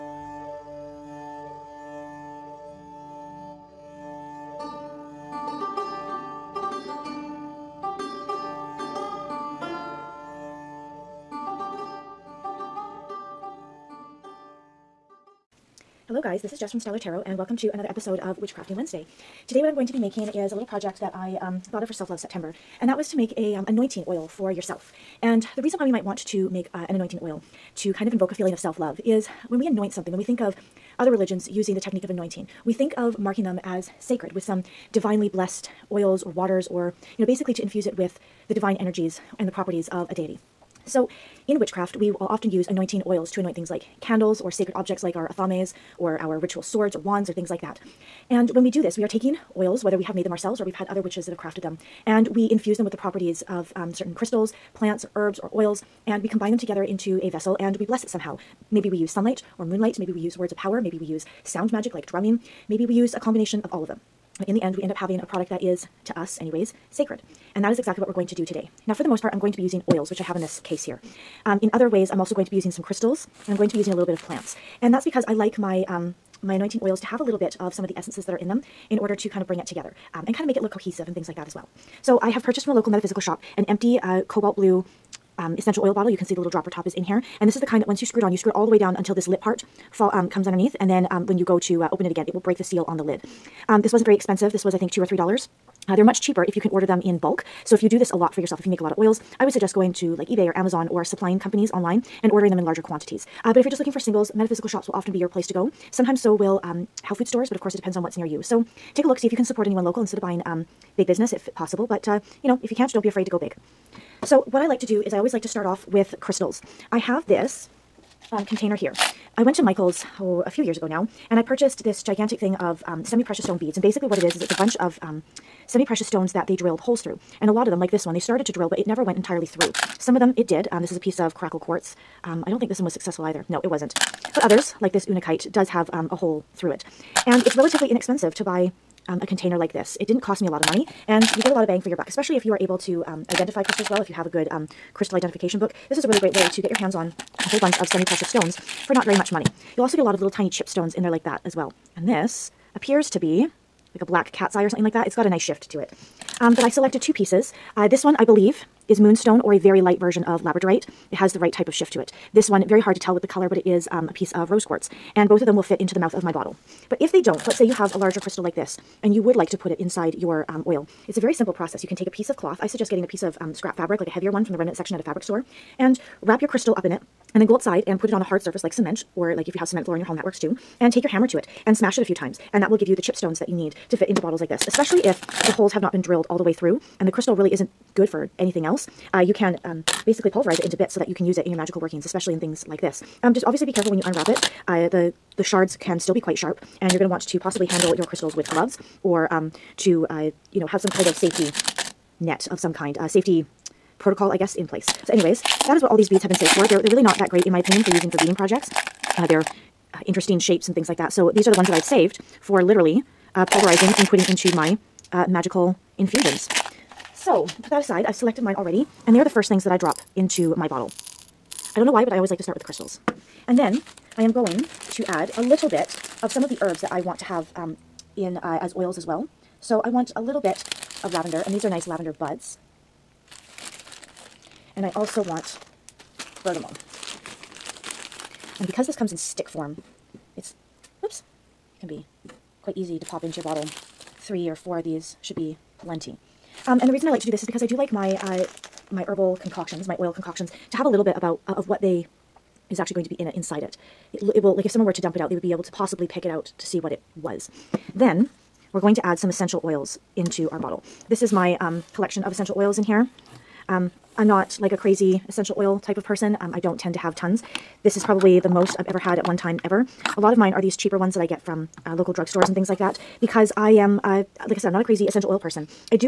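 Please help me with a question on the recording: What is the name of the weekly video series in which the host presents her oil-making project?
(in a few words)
Witchcrafting Wednesday.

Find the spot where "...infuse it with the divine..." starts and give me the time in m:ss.
0:37.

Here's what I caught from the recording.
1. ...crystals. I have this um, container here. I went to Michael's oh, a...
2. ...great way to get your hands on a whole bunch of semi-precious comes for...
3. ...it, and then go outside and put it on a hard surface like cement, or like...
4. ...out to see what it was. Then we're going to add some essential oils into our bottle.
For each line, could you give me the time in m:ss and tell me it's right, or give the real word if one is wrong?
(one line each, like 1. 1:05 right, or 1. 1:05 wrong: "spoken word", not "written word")
1. 1:56 right
2. 2:26 wrong: "stones", not "comes"
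3. 2:56 right
4. 4:16 right.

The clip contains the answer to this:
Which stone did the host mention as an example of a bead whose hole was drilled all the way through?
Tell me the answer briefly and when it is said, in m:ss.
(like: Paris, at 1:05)
Unakite, at 2:15.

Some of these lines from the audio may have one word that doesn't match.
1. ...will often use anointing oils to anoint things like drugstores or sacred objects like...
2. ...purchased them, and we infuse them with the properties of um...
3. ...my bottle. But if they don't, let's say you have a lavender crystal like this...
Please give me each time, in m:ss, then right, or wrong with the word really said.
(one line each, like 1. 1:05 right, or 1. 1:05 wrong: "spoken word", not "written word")
1. 0:42 wrong: "candles", not "drugstores"
2. 0:51 wrong: "crafted", not "purchased"
3. 2:46 wrong: "larger", not "lavender".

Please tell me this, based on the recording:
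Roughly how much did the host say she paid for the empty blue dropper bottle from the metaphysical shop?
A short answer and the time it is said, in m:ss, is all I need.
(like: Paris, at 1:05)
2 or 3 dollars, at 1:34.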